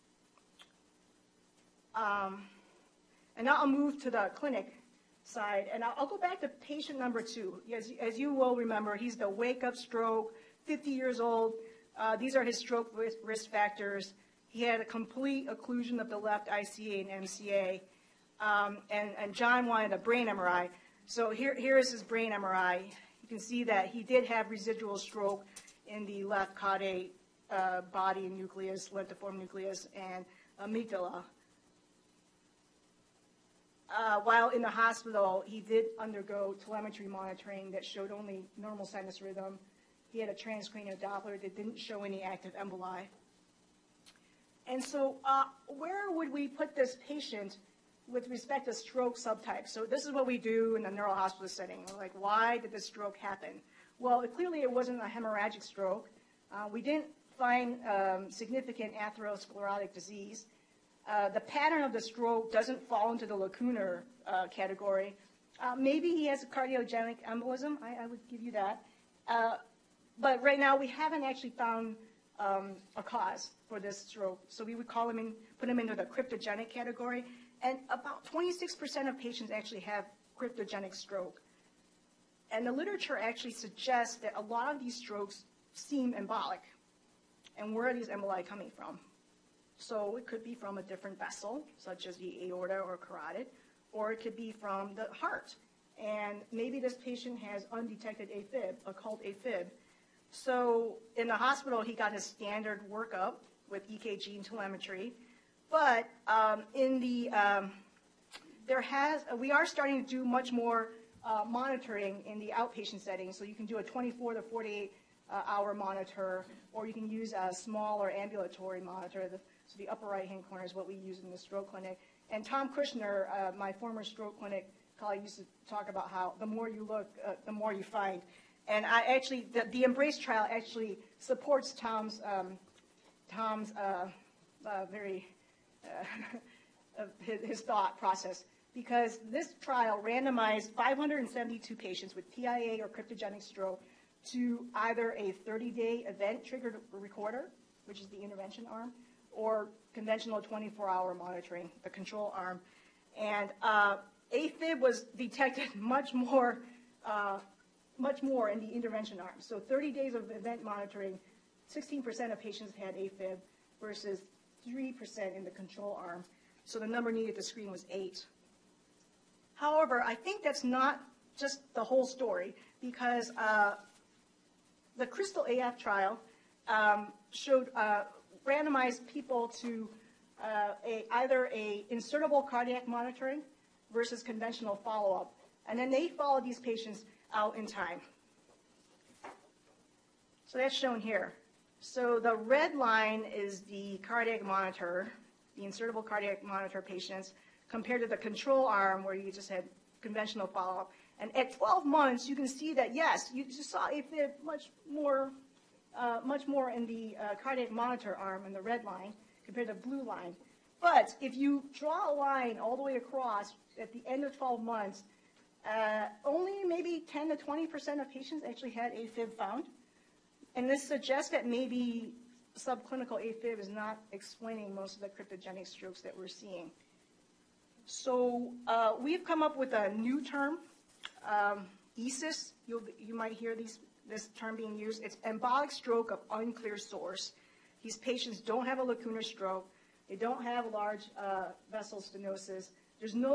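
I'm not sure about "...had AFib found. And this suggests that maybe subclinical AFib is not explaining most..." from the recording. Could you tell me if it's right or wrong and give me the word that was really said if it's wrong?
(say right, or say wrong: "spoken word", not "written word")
right.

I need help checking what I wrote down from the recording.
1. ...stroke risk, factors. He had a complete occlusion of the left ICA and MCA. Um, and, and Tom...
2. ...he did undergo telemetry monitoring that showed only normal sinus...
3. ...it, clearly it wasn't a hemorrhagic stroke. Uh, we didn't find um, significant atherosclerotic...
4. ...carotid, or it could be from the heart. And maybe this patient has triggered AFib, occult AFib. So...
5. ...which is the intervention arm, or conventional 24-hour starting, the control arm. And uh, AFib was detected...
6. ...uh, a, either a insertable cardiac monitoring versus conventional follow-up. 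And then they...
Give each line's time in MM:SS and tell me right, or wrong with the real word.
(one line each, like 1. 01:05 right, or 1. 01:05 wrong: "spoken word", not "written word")
1. 00:12 wrong: "John", not "Tom"
2. 00:35 right
3. 00:54 right
4. 01:32 wrong: "undetected", not "triggered"
5. 02:27 wrong: "monitoring", not "starting"
6. 03:00 right.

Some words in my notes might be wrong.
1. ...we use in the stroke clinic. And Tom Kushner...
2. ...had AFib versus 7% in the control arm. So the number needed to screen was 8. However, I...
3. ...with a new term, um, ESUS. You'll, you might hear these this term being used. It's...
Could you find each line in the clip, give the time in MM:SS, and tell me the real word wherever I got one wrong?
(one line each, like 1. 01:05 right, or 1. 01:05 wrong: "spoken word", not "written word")
1. 02:00 right
2. 02:42 wrong: "3", not "7"
3. 03:49 right.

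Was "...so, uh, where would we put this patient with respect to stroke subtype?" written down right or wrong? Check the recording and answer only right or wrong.
right.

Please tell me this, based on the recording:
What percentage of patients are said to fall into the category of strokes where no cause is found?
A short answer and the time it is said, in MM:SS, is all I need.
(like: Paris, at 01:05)
26%, at 01:18.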